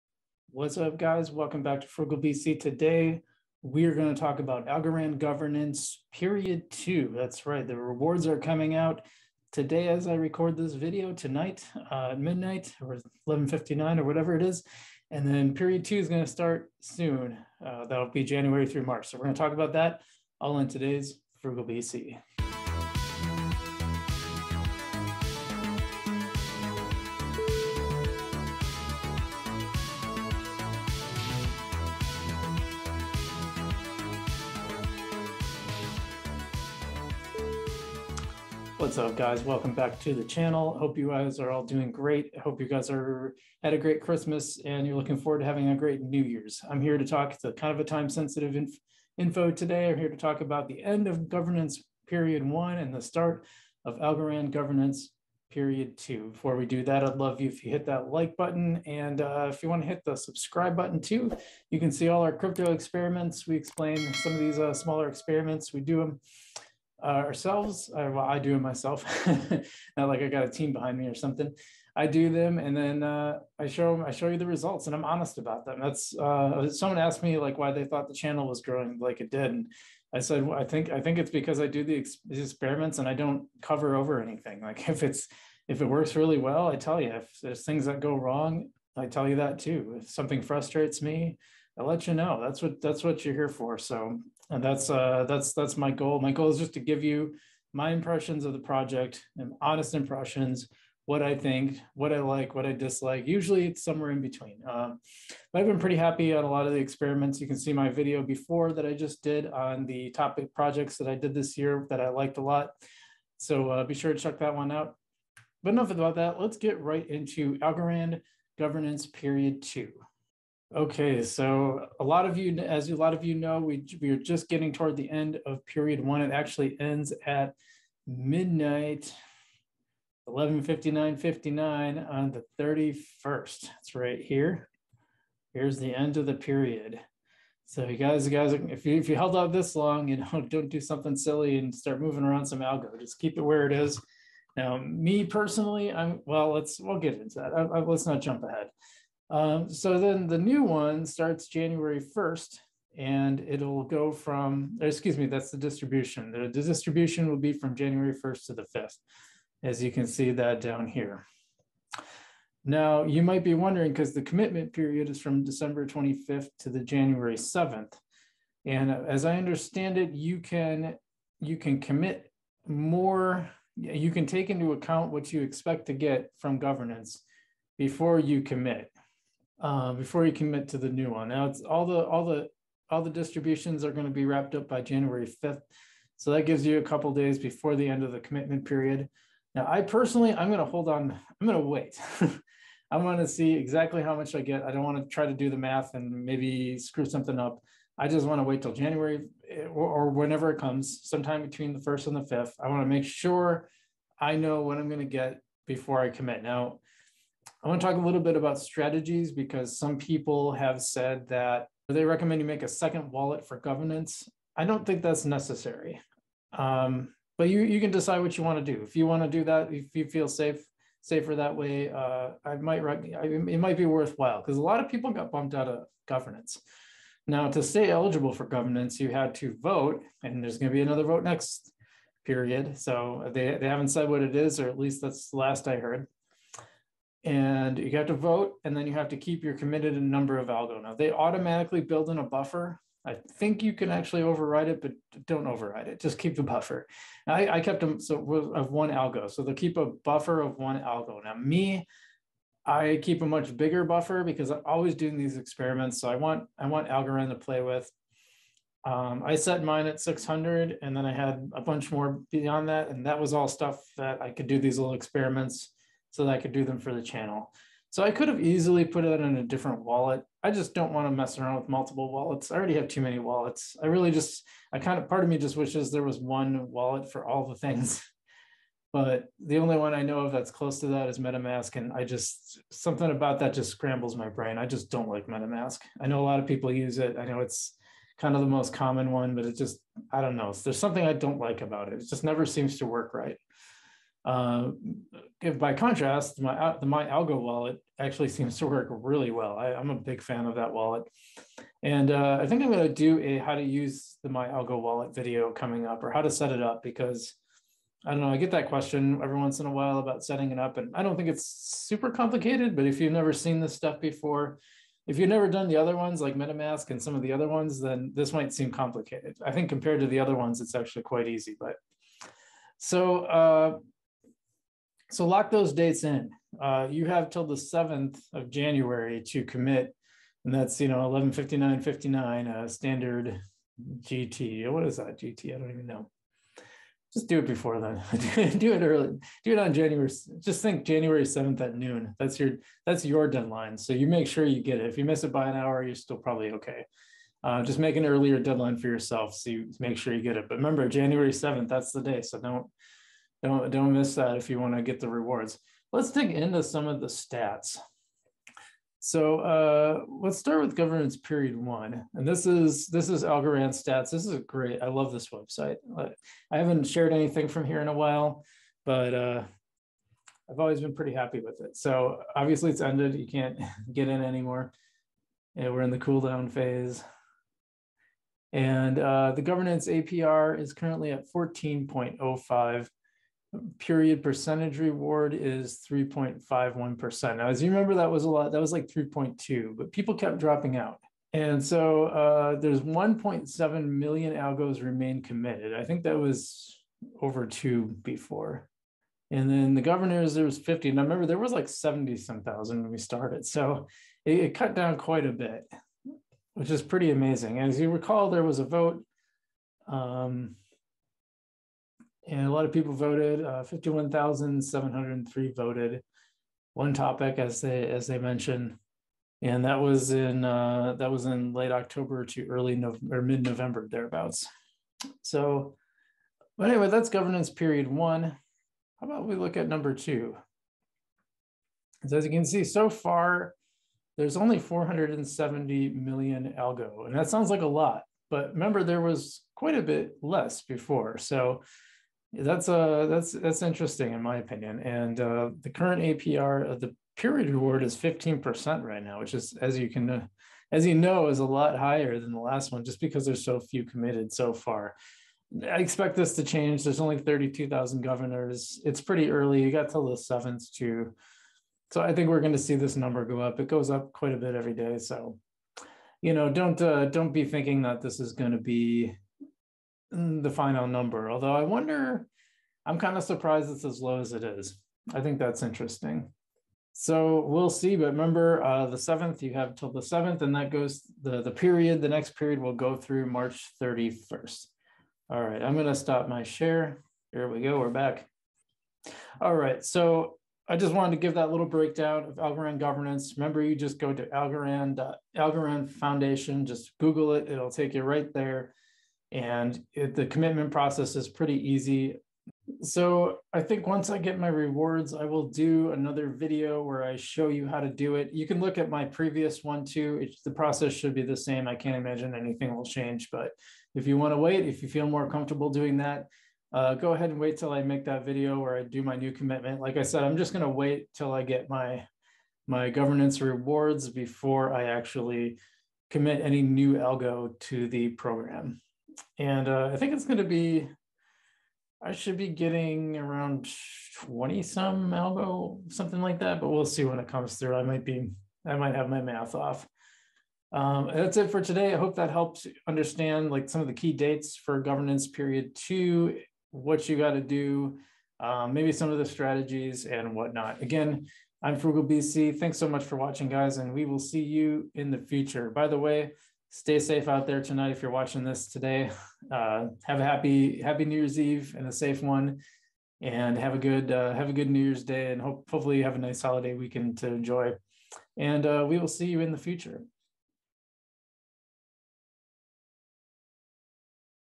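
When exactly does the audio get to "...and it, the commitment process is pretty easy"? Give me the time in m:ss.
8:19.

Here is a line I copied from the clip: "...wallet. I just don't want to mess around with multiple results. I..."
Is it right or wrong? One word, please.
wrong.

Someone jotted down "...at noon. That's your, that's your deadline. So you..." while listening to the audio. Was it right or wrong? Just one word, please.
right.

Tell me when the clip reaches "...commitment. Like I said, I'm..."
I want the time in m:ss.
8:39.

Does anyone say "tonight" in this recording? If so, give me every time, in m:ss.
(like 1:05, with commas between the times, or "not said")
0:11, 9:17.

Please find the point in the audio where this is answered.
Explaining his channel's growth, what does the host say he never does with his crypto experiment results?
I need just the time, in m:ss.
1:23.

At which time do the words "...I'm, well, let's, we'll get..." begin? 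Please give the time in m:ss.
2:25.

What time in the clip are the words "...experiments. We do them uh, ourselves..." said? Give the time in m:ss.
1:05.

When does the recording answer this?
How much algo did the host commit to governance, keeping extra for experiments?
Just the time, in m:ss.
4:19.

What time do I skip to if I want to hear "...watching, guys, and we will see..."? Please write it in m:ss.
9:13.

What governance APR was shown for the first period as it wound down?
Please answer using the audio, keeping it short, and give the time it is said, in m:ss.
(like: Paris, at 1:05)
14.05%, at 6:21.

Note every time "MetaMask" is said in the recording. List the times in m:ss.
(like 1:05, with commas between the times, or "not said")
4:41, 4:45, 5:16.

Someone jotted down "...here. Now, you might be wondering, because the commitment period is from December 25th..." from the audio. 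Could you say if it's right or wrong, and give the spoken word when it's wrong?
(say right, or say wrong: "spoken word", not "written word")
right.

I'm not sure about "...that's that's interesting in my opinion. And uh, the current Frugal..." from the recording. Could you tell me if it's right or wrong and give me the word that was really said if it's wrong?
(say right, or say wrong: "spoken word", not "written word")
wrong: "APR", not "Frugal".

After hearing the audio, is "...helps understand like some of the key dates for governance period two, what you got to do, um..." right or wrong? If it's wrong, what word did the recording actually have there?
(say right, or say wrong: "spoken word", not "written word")
right.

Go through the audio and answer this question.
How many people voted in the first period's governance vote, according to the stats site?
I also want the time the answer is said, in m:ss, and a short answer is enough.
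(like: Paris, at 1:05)
51,703, at 6:53.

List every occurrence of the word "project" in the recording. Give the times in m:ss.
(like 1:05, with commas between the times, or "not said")
1:38, 1:50.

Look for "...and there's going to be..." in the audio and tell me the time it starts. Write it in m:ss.
3:50.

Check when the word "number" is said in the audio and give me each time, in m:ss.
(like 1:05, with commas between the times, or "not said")
4:00, 7:09, 7:42, 7:50.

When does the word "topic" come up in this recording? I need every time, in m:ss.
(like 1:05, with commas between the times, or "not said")
1:50, 6:56.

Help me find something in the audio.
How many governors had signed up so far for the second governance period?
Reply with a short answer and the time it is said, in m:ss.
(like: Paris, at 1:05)
32,000, at 7:37.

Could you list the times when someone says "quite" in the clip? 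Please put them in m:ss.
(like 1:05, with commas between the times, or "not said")
5:21, 6:44, 7:19, 7:44.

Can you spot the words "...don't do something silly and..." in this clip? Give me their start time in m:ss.
2:20.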